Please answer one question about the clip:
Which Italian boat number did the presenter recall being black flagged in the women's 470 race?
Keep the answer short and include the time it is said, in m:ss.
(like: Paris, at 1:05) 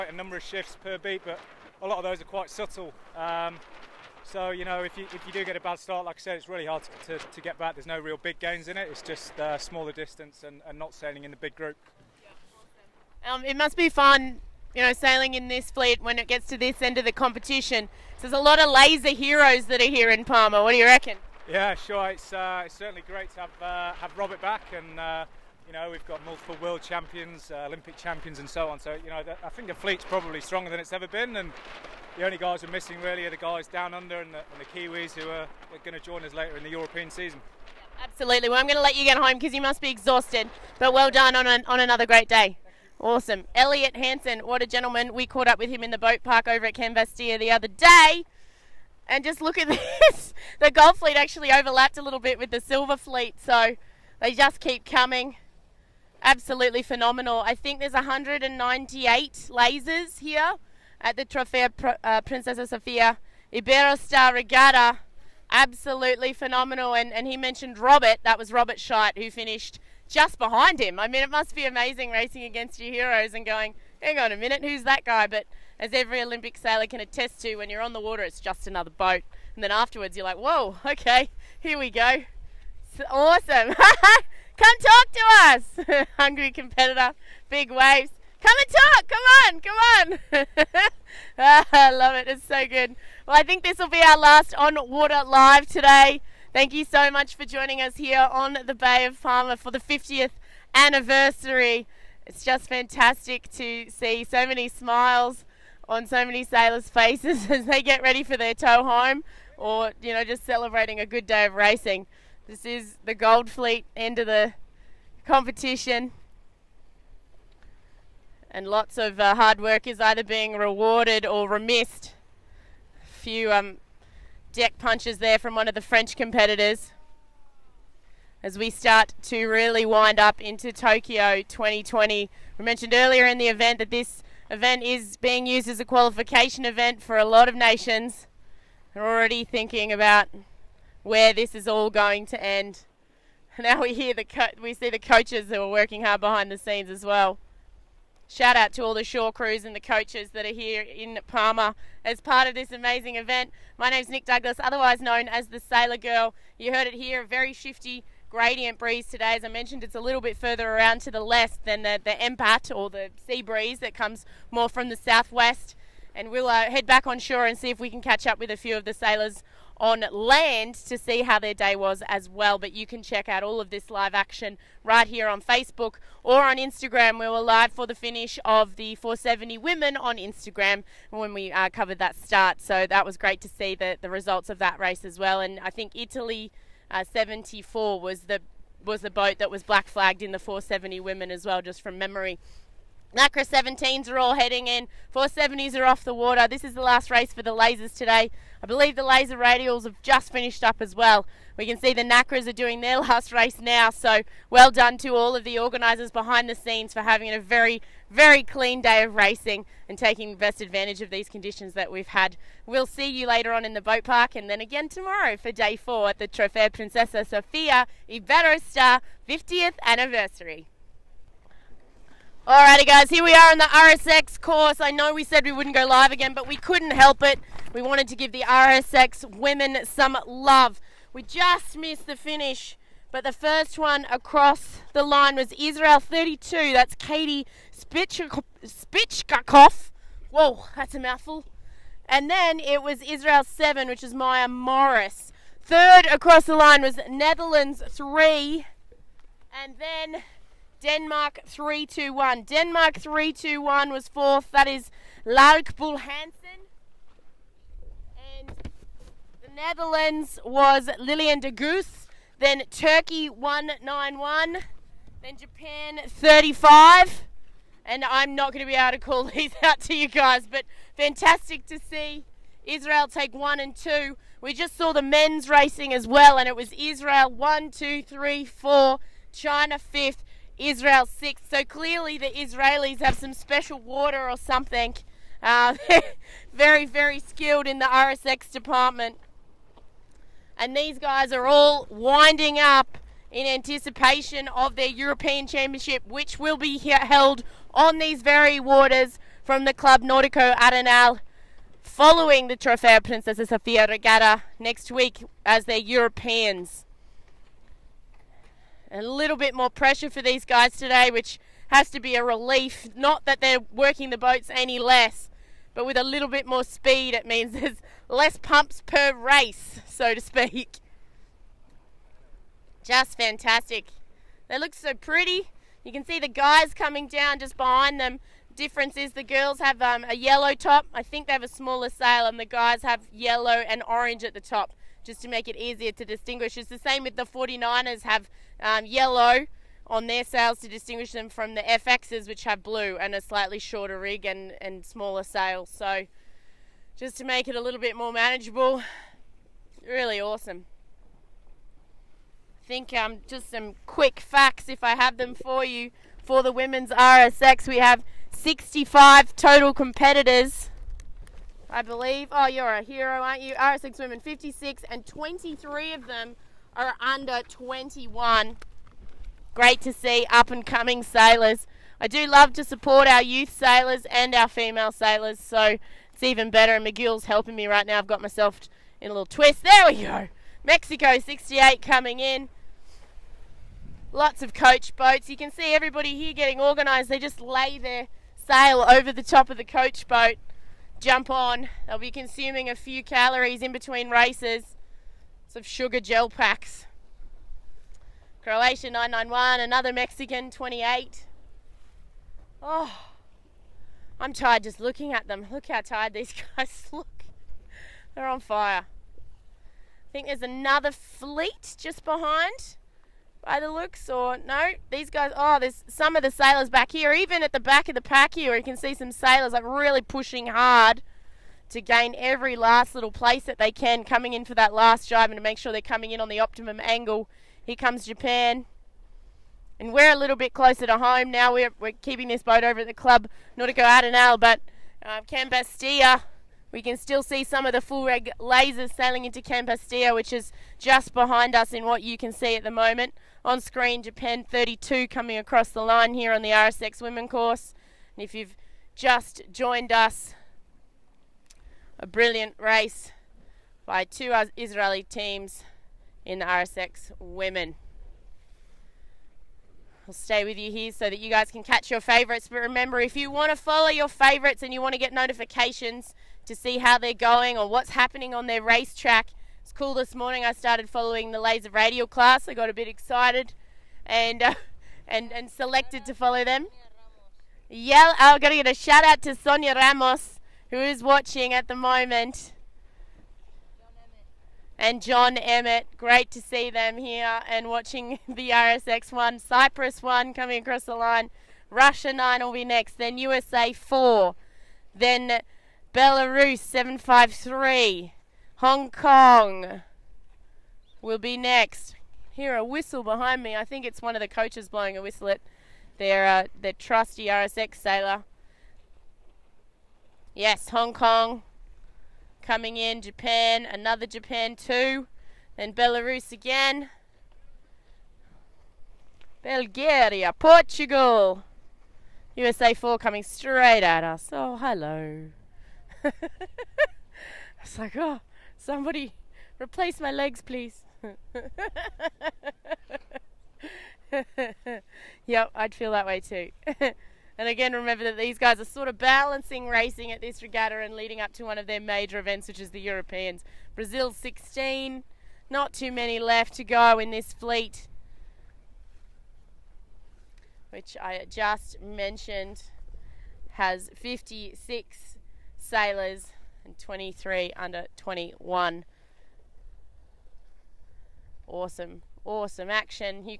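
74, at 3:07.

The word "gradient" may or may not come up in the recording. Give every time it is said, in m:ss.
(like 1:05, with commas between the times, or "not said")
2:38.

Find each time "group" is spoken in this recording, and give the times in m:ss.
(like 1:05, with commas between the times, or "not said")
0:11.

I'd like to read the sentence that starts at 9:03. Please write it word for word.
Brazil 16, not too many left to go in this fleet, which I just mentioned has 56 sailors and 23 under 21.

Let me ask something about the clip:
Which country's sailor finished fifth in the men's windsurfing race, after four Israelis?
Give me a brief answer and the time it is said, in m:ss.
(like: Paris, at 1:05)
China, at 4:39.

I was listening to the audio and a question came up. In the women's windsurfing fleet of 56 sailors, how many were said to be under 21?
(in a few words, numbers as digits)
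23.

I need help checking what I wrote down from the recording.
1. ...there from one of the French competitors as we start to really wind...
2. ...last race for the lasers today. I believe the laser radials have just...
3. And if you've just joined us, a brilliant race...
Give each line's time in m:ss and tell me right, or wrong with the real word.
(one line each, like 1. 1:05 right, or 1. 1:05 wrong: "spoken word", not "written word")
1. 2:05 right
2. 3:16 right
3. 7:28 right.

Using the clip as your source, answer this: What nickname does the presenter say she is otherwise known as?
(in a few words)
the Sailor Girl.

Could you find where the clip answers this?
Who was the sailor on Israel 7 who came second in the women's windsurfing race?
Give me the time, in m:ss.
4:04.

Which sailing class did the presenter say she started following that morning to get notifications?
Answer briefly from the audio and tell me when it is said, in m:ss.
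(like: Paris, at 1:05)
Laser Radial, at 7:51.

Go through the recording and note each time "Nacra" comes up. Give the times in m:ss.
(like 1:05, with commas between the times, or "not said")
3:13, 3:22.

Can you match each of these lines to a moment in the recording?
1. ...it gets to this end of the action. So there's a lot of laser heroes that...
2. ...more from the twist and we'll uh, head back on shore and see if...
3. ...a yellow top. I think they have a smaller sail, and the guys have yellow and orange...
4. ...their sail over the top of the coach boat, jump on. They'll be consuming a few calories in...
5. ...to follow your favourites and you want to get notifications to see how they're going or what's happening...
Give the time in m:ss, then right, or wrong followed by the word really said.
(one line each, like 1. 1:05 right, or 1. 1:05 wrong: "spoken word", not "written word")
1. 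0:16 wrong: "competition", not "action"
2. 2:44 wrong: "southwest", not "twist"
3. 5:30 right
4. 6:27 right
5. 7:43 right.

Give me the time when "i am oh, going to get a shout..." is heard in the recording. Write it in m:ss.
7:58.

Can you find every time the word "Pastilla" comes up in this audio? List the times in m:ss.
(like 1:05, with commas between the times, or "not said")
0:46, 7:15, 7:19.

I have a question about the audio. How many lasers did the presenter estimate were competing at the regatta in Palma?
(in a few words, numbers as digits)
198.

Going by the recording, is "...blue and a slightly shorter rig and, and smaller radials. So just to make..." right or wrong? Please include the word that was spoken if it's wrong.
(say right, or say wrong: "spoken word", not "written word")
wrong: "sails", not "radials".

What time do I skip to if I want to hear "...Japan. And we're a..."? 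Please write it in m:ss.
7:08.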